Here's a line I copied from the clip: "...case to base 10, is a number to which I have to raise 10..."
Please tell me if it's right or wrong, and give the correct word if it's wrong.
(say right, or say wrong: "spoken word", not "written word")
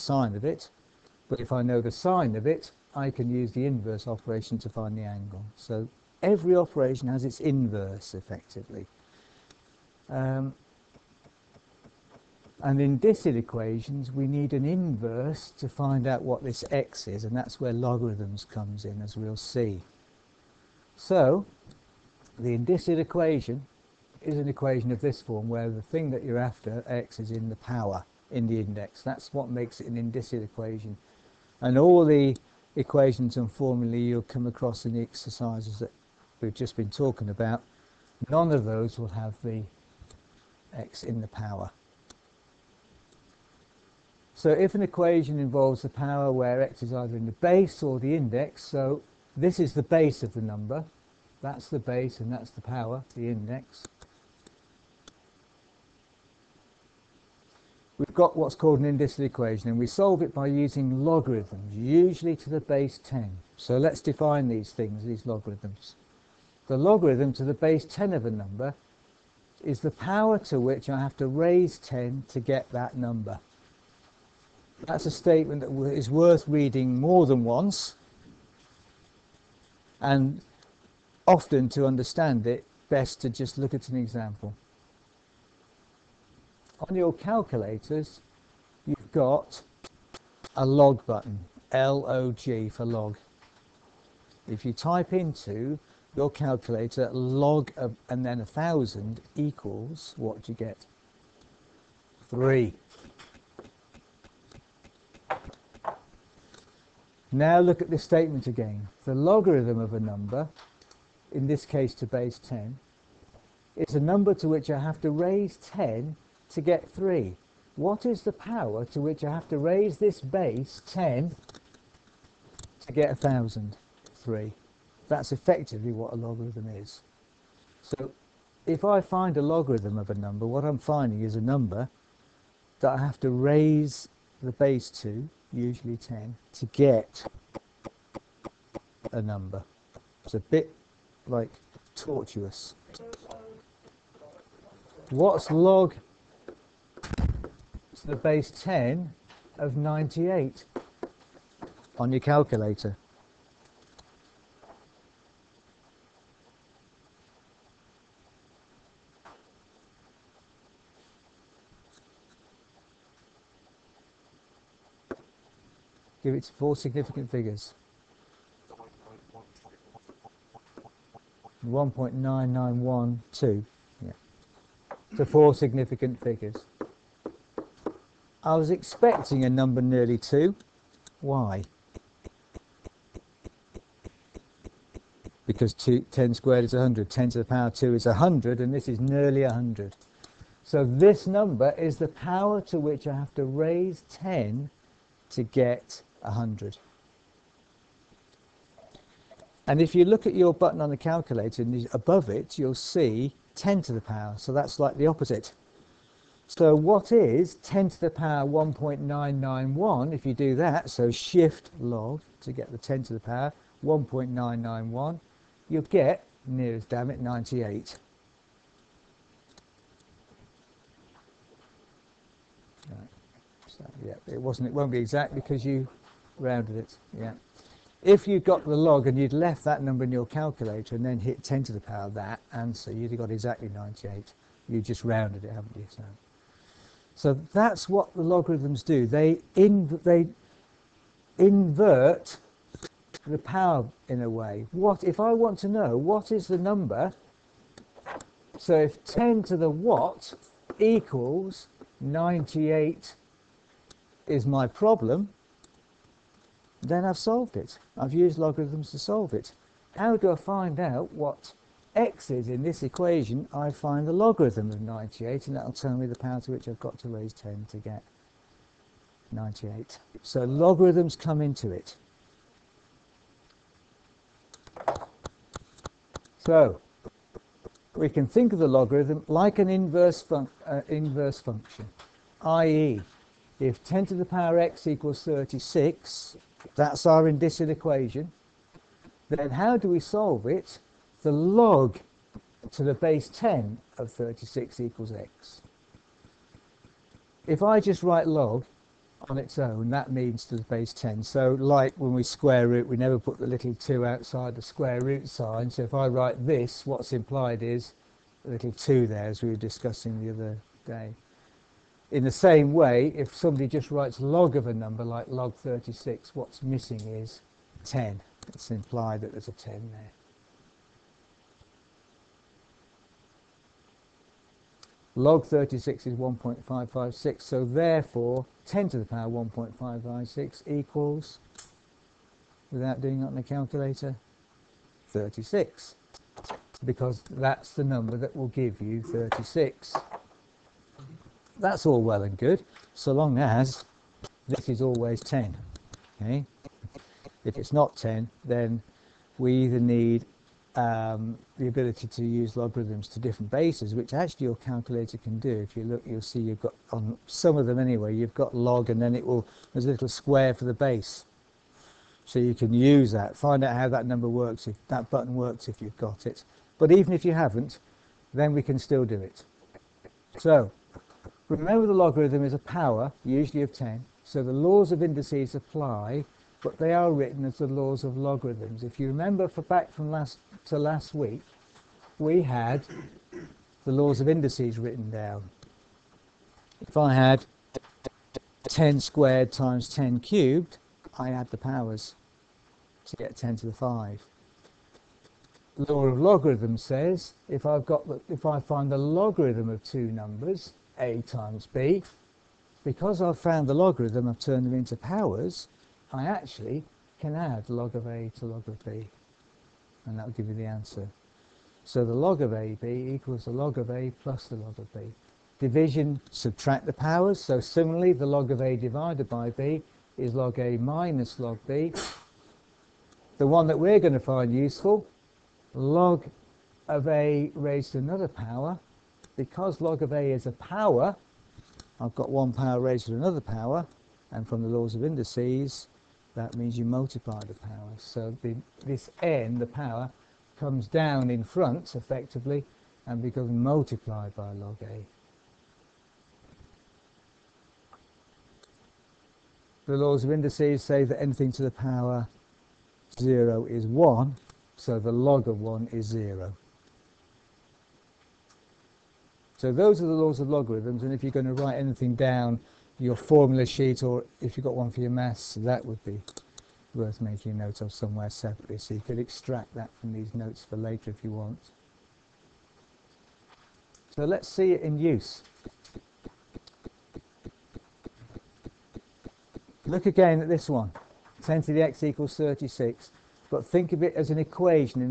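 right.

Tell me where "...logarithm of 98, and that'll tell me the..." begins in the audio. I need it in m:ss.
4:24.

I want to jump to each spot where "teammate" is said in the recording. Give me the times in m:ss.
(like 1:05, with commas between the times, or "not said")
not said.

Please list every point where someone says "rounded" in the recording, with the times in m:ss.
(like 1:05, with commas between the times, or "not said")
3:46, 3:55.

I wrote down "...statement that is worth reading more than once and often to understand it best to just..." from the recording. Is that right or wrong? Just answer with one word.
right.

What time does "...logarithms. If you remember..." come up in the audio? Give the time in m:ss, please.
6:18.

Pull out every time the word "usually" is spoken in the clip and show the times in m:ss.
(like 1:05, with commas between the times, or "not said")
1:01, 2:15, 6:13.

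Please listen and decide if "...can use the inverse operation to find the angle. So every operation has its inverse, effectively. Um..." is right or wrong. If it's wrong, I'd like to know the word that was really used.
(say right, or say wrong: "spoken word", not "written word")
right.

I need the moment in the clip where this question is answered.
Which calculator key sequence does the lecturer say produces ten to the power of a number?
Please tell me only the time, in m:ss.
3:31.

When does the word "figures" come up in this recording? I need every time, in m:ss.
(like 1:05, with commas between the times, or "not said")
2:47, 2:56.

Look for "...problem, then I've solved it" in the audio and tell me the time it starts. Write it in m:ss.
4:14.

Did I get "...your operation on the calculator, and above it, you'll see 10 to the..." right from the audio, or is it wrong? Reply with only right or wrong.
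wrong.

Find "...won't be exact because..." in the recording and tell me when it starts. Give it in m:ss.
3:44.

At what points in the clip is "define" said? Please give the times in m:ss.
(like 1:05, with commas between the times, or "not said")
1:03.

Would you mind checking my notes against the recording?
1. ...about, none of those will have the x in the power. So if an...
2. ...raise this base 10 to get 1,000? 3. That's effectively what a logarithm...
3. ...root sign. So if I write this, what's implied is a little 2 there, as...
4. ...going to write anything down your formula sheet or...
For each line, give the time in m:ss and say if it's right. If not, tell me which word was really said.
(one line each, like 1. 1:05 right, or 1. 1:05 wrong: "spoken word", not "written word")
1. 0:37 right
2. 1:59 right
3. 5:05 right
4. 7:41 right.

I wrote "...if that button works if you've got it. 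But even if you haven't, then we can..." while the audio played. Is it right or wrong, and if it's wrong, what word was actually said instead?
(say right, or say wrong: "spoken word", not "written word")
right.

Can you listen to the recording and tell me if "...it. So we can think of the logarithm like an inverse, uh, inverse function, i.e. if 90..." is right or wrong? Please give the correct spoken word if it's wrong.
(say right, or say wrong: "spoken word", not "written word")
wrong: "10", not "90".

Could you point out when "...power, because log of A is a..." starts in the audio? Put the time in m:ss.
7:08.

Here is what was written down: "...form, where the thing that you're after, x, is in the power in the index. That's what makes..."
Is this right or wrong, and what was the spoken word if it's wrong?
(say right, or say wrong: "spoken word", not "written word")
right.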